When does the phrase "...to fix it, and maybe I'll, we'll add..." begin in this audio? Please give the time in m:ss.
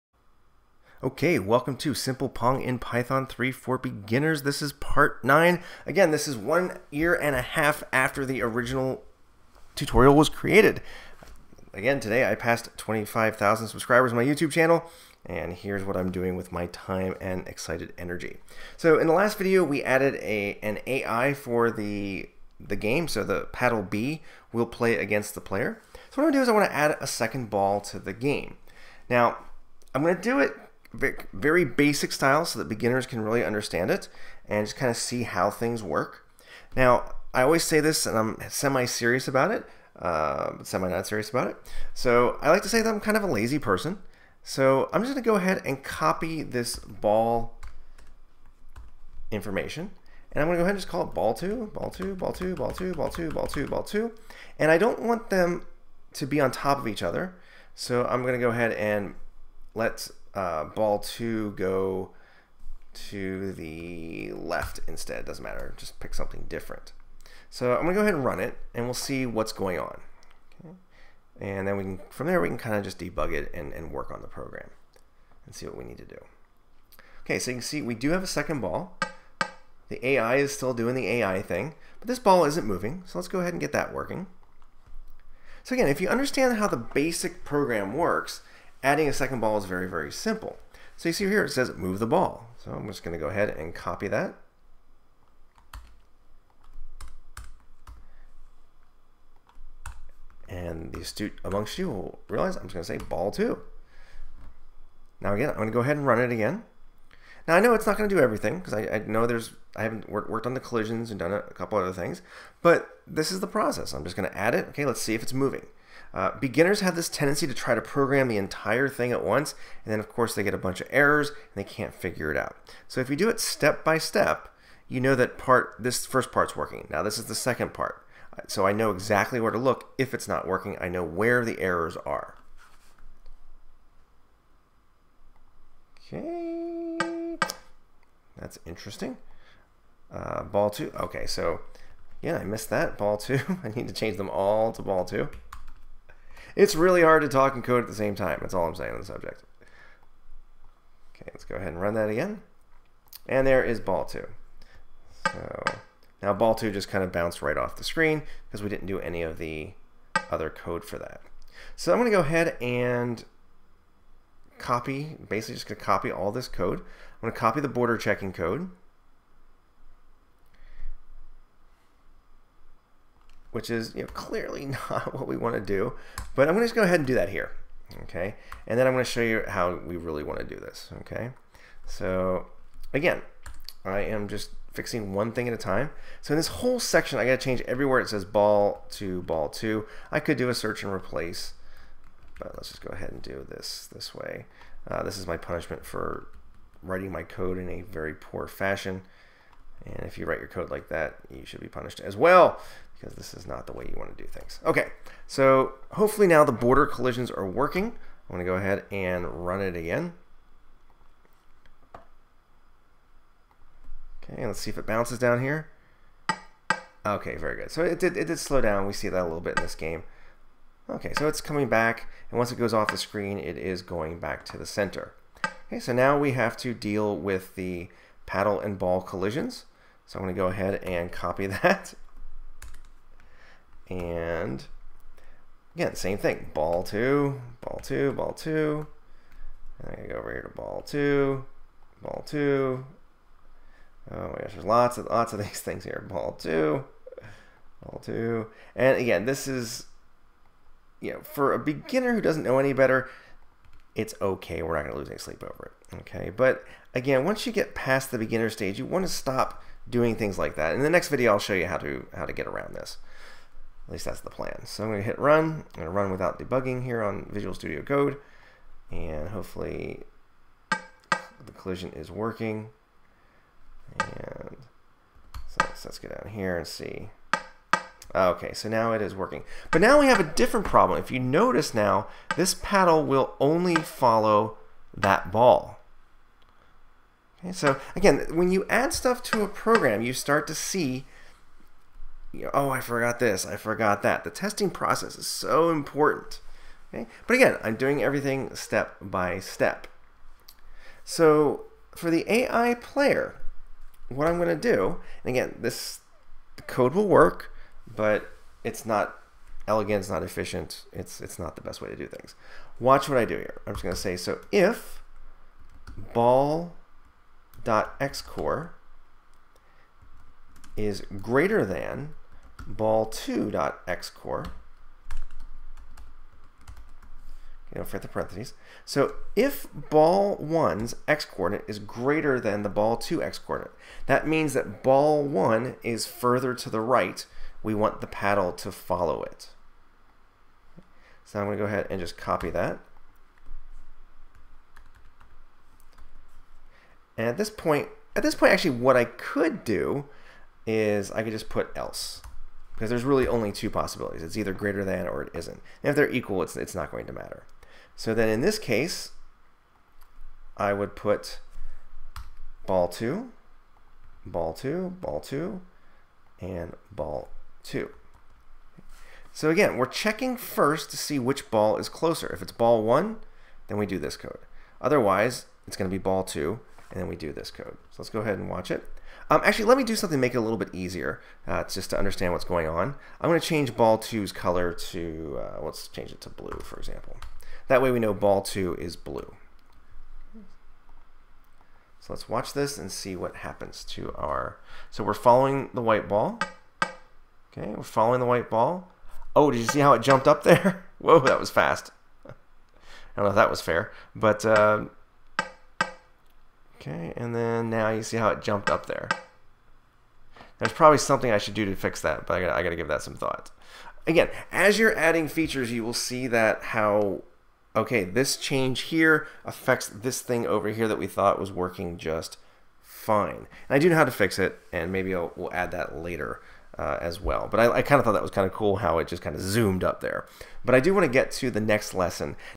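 7:04.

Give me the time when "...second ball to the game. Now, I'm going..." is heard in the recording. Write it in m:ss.
0:27.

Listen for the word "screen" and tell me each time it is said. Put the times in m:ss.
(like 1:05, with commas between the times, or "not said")
2:37, 3:42.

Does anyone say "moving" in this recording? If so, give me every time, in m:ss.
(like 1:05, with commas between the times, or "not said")
1:22, 1:55.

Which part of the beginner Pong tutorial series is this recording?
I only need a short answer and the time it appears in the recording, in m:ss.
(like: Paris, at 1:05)
Part 9, at 0:04.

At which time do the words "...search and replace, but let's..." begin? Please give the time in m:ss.
3:10.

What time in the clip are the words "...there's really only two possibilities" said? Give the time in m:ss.
5:52.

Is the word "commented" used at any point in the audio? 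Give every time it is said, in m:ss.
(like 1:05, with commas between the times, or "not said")
not said.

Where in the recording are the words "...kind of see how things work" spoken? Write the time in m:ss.
0:34.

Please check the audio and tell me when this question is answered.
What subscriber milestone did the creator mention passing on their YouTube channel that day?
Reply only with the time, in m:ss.
0:12.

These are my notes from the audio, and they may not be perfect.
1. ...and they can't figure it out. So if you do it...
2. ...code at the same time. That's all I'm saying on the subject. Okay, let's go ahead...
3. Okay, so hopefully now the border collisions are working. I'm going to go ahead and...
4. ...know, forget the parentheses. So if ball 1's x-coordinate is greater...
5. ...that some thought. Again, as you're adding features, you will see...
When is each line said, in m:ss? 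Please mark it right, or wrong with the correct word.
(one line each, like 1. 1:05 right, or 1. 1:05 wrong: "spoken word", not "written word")
1. 2:01 right
2. 2:27 right
3. 3:24 right
4. 5:27 right
5. 6:52 right.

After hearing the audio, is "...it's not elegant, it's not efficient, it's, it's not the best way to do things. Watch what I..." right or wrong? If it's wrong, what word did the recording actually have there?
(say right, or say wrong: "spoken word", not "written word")
right.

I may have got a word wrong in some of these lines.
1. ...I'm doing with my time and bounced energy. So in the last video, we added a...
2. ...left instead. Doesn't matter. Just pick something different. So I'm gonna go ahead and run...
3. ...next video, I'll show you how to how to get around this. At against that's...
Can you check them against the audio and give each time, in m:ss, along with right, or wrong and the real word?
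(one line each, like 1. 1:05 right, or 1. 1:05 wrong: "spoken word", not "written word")
1. 0:15 wrong: "excited", not "bounced"
2. 1:04 right
3. 4:20 wrong: "least", not "against".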